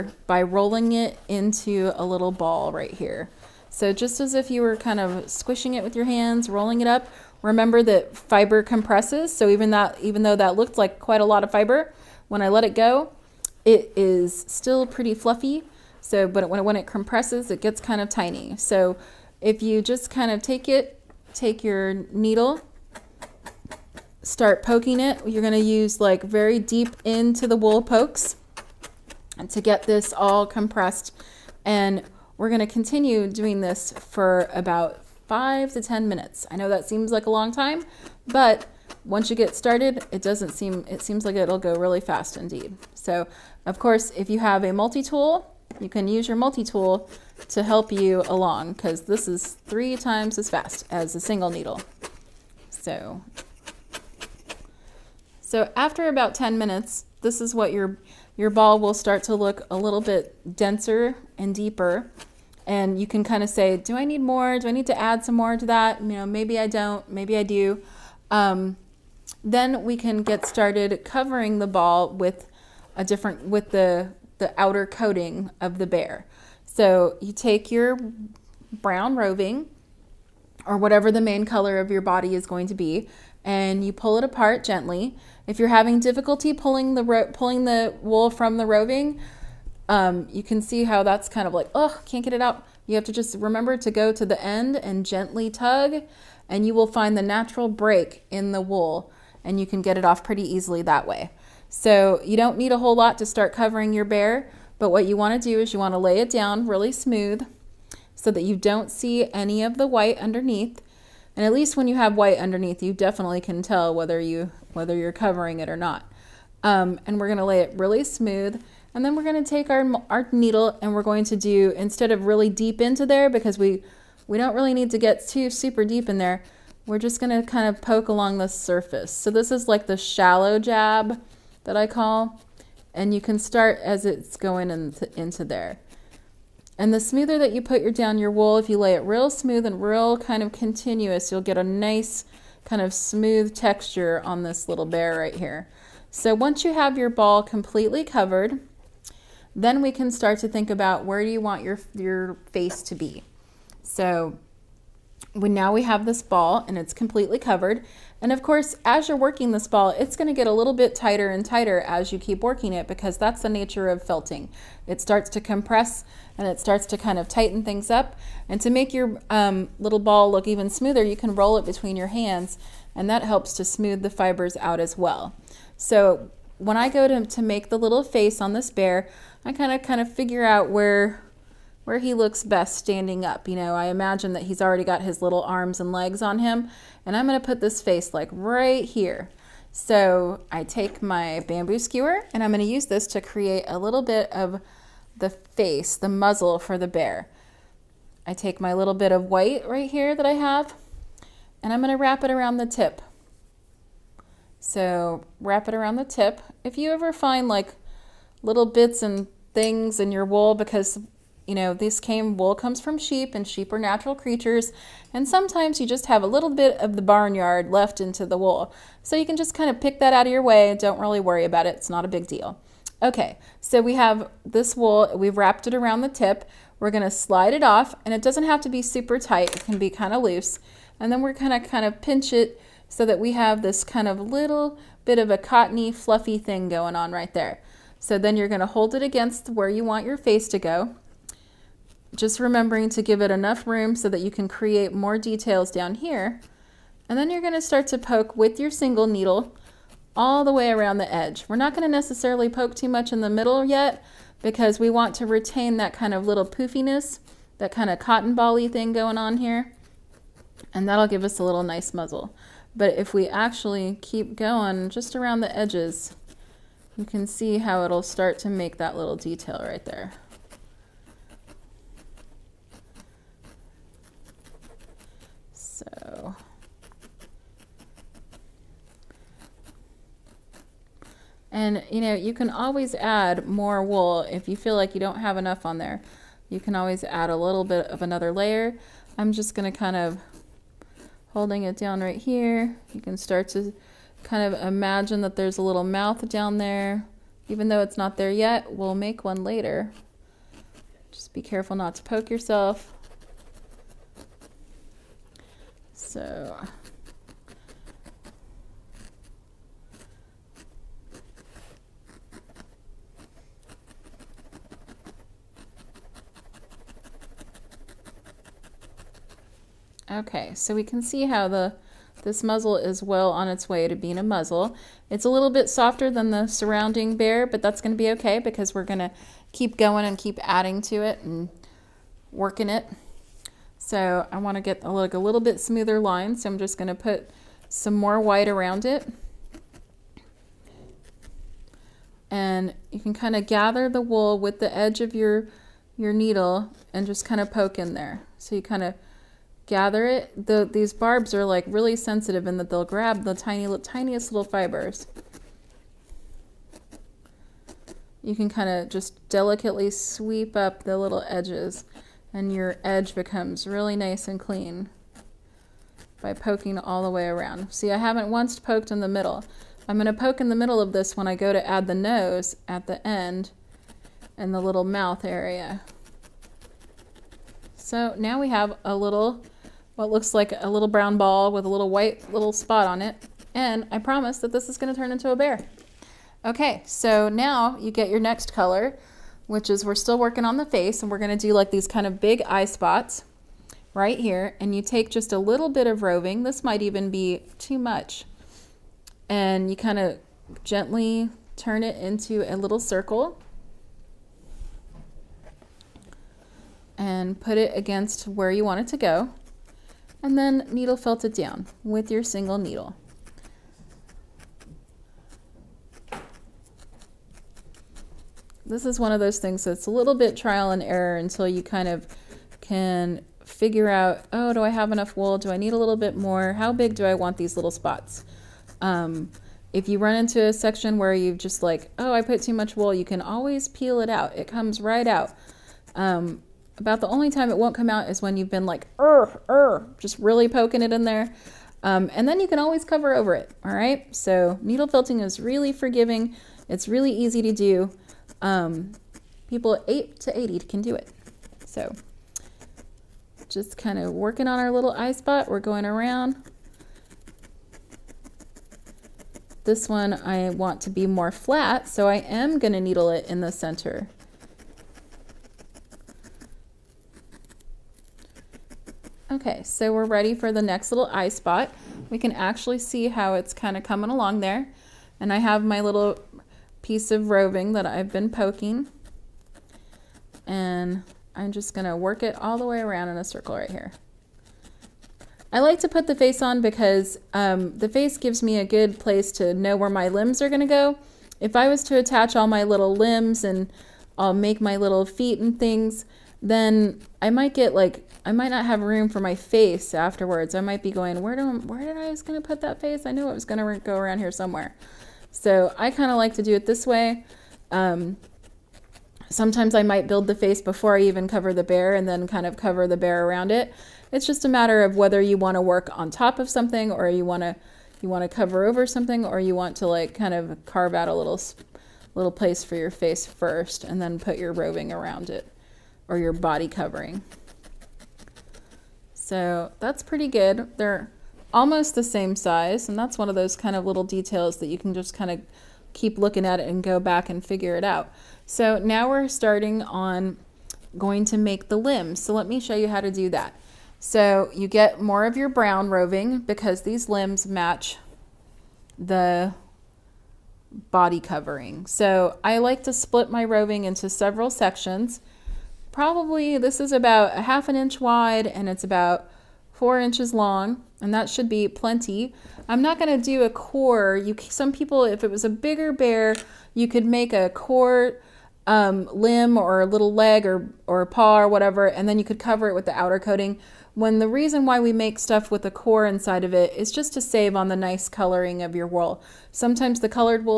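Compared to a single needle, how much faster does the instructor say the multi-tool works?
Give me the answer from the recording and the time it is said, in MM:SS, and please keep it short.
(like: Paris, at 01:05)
3 times, at 00:49.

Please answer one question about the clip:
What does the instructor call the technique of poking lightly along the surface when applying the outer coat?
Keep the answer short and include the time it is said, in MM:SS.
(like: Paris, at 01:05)
shallow jab, at 02:09.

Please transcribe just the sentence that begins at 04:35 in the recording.
So And you know, you can always add more wool if you feel like you don't have enough on there.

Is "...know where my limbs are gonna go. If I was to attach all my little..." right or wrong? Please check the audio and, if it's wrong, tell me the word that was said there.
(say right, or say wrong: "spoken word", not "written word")
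right.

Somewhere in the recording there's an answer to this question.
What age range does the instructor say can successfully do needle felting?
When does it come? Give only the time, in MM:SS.
07:29.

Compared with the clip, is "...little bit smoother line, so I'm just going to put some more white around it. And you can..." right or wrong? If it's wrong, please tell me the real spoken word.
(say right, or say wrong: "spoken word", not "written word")
right.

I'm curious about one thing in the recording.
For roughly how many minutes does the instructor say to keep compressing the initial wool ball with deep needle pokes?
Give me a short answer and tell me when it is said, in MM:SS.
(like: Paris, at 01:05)
5 to 10 minutes, at 00:34.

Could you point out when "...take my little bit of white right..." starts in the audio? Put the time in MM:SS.
03:18.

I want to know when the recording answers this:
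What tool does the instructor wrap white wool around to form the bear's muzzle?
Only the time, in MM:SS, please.
03:11.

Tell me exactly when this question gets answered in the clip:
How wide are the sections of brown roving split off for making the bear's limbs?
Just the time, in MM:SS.
09:17.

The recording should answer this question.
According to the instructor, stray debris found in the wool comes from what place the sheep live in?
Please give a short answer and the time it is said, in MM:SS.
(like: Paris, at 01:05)
barnyard, at 03:37.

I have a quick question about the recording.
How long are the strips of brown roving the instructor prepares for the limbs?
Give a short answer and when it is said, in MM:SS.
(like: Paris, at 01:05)
4 inches, at 09:19.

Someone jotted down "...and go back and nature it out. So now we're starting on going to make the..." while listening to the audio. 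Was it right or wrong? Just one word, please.
wrong.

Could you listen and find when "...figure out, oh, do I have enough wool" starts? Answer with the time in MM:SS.
07:03.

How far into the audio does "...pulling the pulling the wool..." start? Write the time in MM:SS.
01:26.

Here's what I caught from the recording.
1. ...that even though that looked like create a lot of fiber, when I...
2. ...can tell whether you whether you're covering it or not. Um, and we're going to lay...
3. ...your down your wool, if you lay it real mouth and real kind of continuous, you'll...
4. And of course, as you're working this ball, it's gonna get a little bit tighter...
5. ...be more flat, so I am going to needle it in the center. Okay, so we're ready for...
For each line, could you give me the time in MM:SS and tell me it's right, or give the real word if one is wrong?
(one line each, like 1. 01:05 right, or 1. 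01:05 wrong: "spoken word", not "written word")
1. 00:09 wrong: "quite", not "create"
2. 01:53 right
3. 02:17 wrong: "smooth", not "mouth"
4. 02:38 right
5. 07:40 right.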